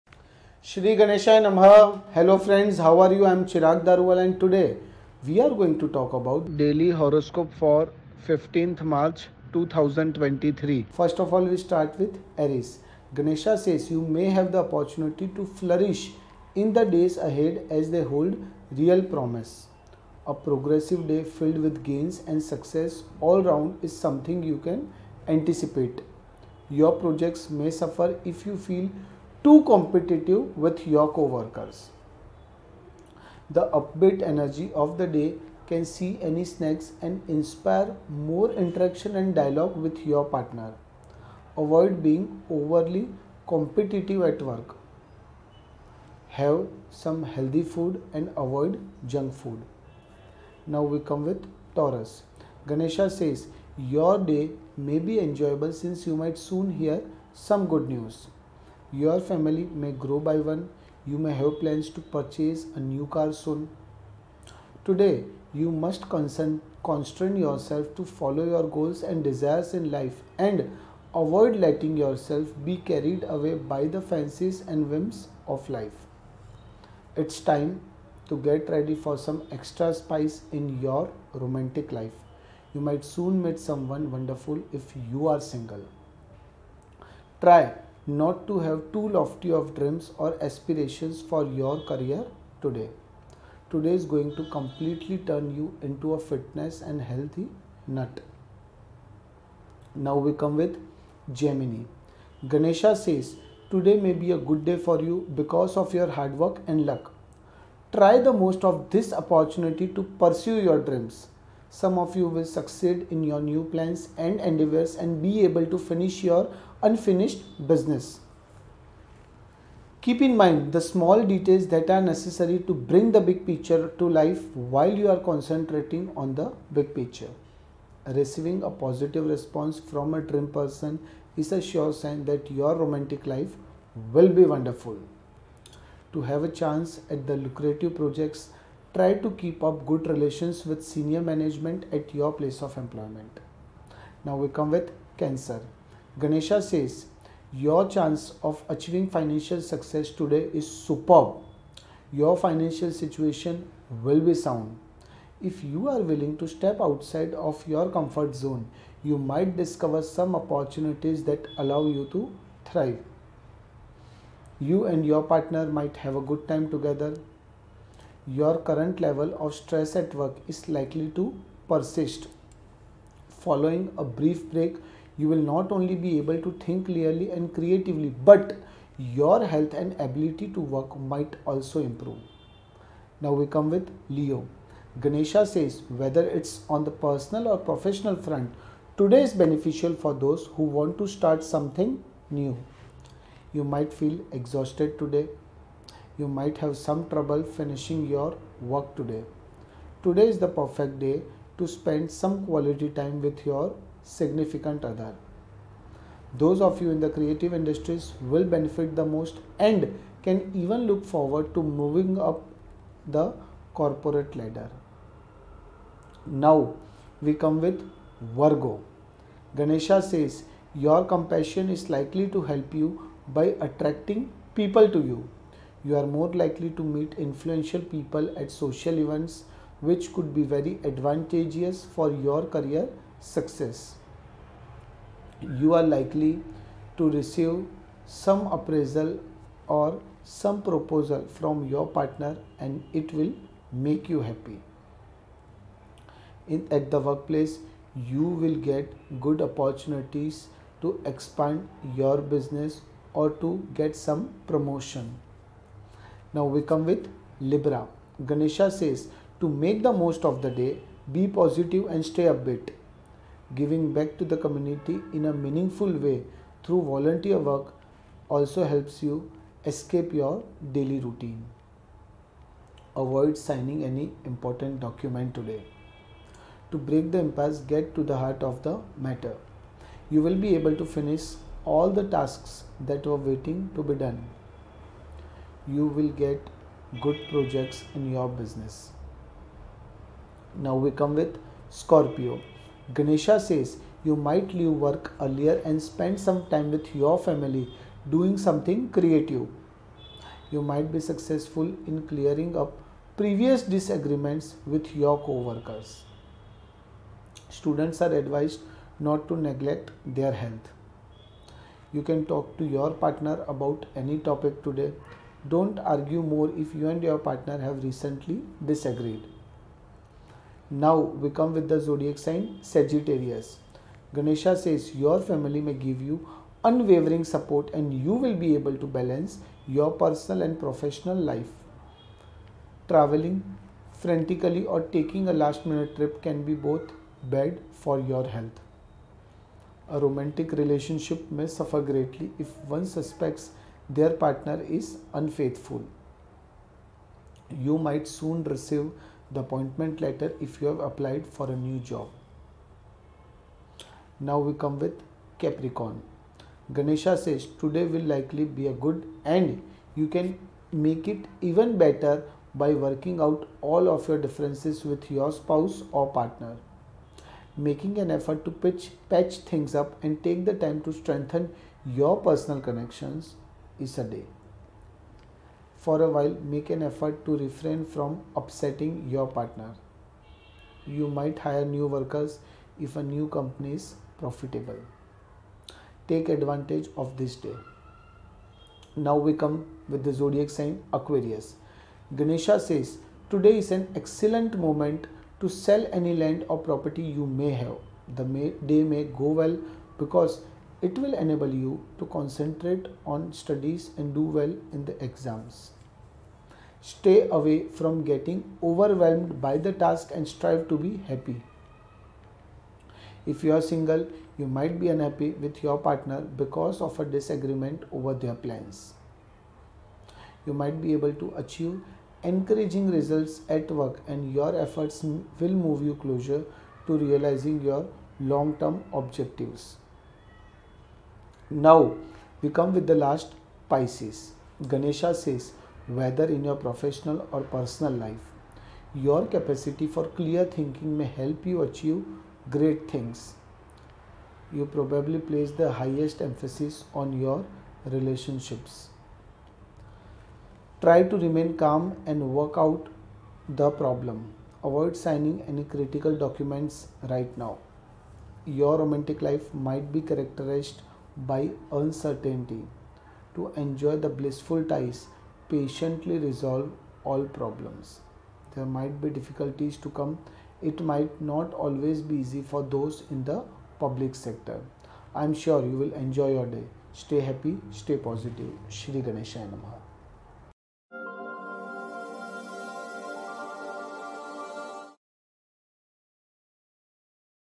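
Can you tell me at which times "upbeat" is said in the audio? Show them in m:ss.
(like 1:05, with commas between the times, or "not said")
0:33, 4:22.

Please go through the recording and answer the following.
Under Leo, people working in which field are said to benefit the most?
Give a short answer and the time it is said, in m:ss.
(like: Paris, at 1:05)
Creative industries, at 3:27.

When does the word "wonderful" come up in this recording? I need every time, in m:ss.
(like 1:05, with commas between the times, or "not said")
1:24, 2:14.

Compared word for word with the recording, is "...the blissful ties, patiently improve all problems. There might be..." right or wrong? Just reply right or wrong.
wrong.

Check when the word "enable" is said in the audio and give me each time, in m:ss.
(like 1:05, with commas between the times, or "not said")
6:41.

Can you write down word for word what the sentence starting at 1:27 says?
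Try not to have too lofty of dreams or aspirations for your career today.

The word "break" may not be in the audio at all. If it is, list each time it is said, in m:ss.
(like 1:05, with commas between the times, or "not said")
2:54, 4:36.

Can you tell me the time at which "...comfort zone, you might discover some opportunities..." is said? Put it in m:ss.
2:37.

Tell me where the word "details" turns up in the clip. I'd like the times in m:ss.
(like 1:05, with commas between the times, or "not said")
2:01.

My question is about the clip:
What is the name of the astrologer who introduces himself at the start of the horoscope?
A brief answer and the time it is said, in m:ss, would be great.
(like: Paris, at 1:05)
Chirag Daruwalla, at 0:03.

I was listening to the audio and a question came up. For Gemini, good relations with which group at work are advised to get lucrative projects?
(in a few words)
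Senior management.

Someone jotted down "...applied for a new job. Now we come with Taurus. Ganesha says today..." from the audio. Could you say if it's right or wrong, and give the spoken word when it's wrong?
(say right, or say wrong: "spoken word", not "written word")
wrong: "Capricorn", not "Taurus".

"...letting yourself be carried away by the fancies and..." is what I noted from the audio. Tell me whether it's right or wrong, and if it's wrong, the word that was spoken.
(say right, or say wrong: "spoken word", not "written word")
right.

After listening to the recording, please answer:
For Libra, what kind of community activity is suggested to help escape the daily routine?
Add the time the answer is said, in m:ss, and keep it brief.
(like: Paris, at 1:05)
Volunteer work, at 4:26.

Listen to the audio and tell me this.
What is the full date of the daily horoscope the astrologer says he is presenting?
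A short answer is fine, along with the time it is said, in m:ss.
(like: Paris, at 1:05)
15th March 2023, at 0:08.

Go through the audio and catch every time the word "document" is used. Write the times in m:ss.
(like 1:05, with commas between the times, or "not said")
4:34, 7:36.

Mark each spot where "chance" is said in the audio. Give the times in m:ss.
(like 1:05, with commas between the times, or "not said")
2:16, 2:27.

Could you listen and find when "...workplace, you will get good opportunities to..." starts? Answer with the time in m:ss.
4:06.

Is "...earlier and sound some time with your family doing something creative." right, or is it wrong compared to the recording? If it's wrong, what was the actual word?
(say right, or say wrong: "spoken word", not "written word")
wrong: "spend", not "sound".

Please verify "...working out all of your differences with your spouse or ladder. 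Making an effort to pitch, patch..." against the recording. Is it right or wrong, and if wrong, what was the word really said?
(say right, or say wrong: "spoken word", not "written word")
wrong: "partner", not "ladder".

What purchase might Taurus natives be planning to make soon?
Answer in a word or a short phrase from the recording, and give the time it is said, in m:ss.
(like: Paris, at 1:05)
A new car, at 1:02.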